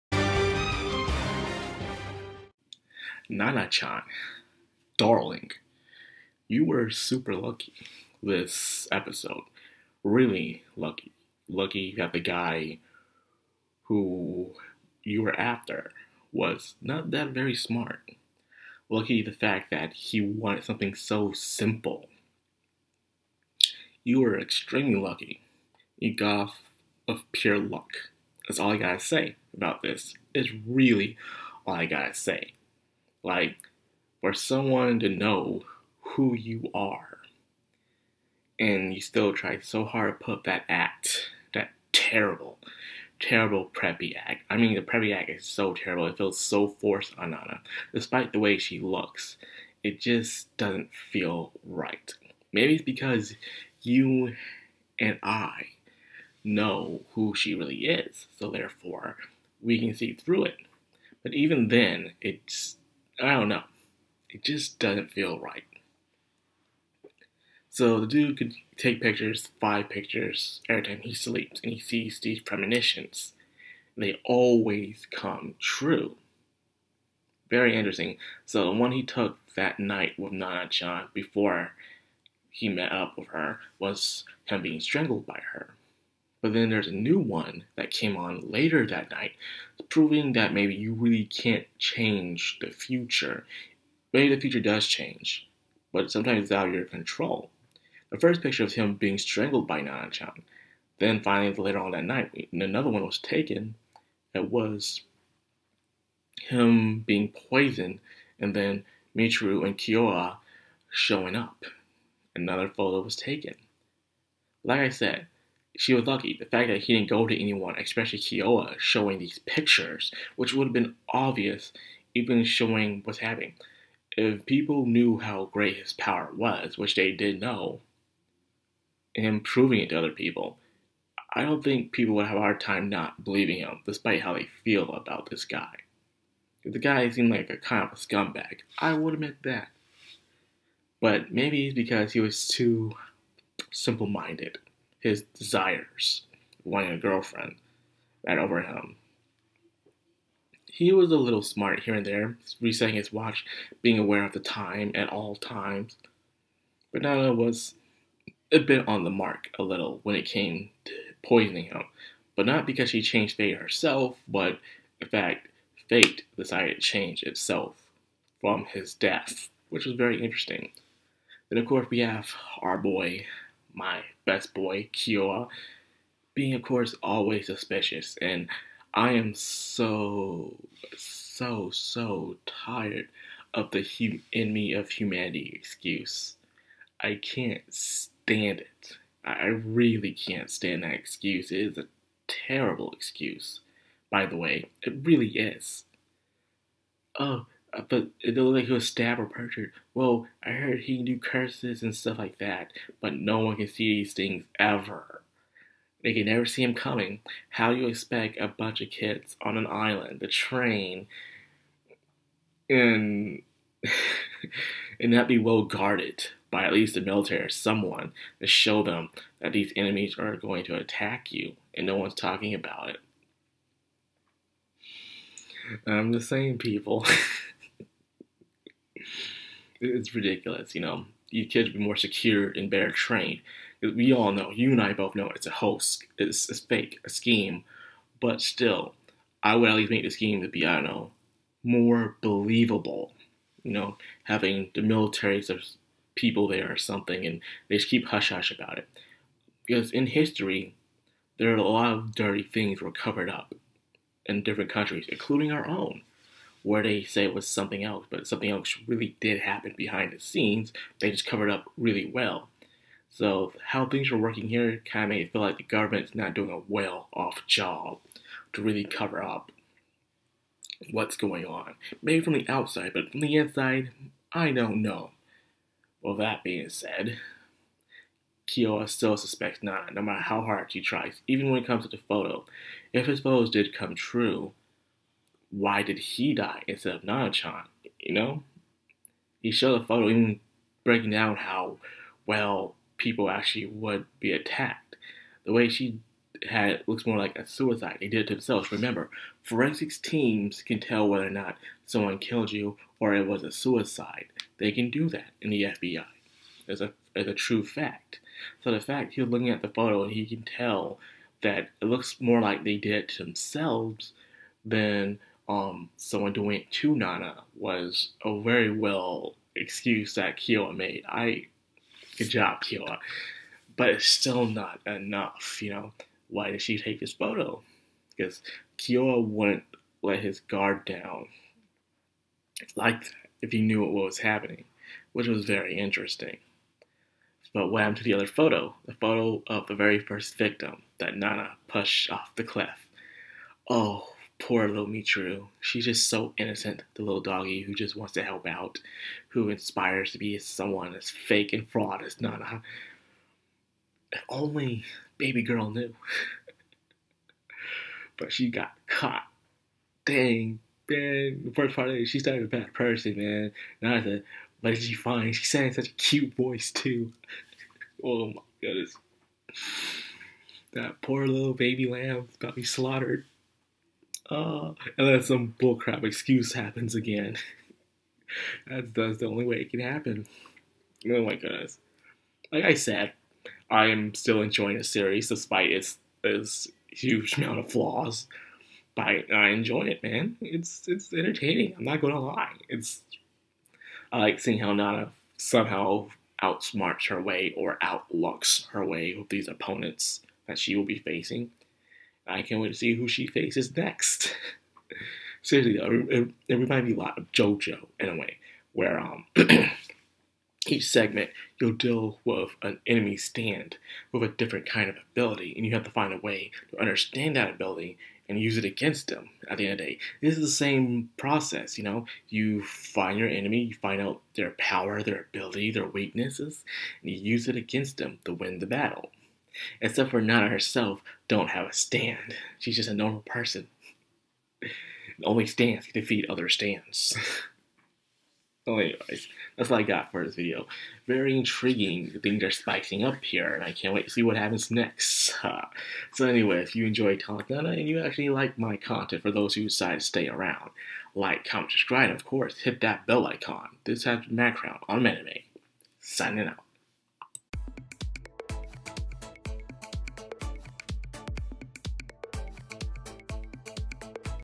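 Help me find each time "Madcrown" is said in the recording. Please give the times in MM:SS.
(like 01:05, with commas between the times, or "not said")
07:34.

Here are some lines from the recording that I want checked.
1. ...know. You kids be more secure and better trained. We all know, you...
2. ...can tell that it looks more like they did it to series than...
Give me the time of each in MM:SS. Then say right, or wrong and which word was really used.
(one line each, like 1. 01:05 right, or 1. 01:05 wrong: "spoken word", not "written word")
1. 03:50 right
2. 05:10 wrong: "themselves", not "series".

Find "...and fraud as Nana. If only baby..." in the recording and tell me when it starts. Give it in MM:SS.
05:51.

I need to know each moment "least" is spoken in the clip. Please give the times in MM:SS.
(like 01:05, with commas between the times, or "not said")
03:36, 03:59.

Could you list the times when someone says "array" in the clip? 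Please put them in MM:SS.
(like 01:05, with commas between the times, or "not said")
not said.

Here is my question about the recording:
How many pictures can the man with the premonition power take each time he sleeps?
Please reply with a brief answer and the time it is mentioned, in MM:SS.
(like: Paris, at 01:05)
5, at 01:09.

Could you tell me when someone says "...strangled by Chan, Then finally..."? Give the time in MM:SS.
01:39.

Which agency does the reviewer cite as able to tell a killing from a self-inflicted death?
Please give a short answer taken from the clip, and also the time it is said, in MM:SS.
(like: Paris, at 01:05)
FBI, at 05:05.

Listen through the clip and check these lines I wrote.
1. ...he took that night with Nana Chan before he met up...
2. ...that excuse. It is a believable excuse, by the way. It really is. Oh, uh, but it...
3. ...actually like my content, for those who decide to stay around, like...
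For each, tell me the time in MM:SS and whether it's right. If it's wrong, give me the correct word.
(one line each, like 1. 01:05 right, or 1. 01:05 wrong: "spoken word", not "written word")
1. 01:18 right
2. 03:10 wrong: "terrible", not "believable"
3. 07:28 right.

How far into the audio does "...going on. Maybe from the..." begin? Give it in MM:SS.
04:31.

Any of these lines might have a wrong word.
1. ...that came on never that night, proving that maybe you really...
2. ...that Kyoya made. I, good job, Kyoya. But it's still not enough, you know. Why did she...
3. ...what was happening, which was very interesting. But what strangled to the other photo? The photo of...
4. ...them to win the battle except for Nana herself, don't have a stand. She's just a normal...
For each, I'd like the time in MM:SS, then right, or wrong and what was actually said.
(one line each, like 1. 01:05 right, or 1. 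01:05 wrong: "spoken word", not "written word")
1. 01:27 wrong: "later", not "never"
2. 05:20 right
3. 05:33 wrong: "happened", not "strangled"
4. 07:07 right.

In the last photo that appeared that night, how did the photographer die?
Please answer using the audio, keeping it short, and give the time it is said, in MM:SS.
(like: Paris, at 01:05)
Poisoned, at 01:47.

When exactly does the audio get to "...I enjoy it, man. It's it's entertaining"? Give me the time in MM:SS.
06:29.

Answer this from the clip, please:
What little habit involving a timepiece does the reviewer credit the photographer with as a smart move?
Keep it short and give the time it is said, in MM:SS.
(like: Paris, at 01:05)
Resetting his watch, at 02:32.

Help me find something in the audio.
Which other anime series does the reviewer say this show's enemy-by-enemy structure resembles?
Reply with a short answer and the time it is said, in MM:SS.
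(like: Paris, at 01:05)
JoJo, at 06:47.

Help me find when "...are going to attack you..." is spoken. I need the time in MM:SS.
03:40.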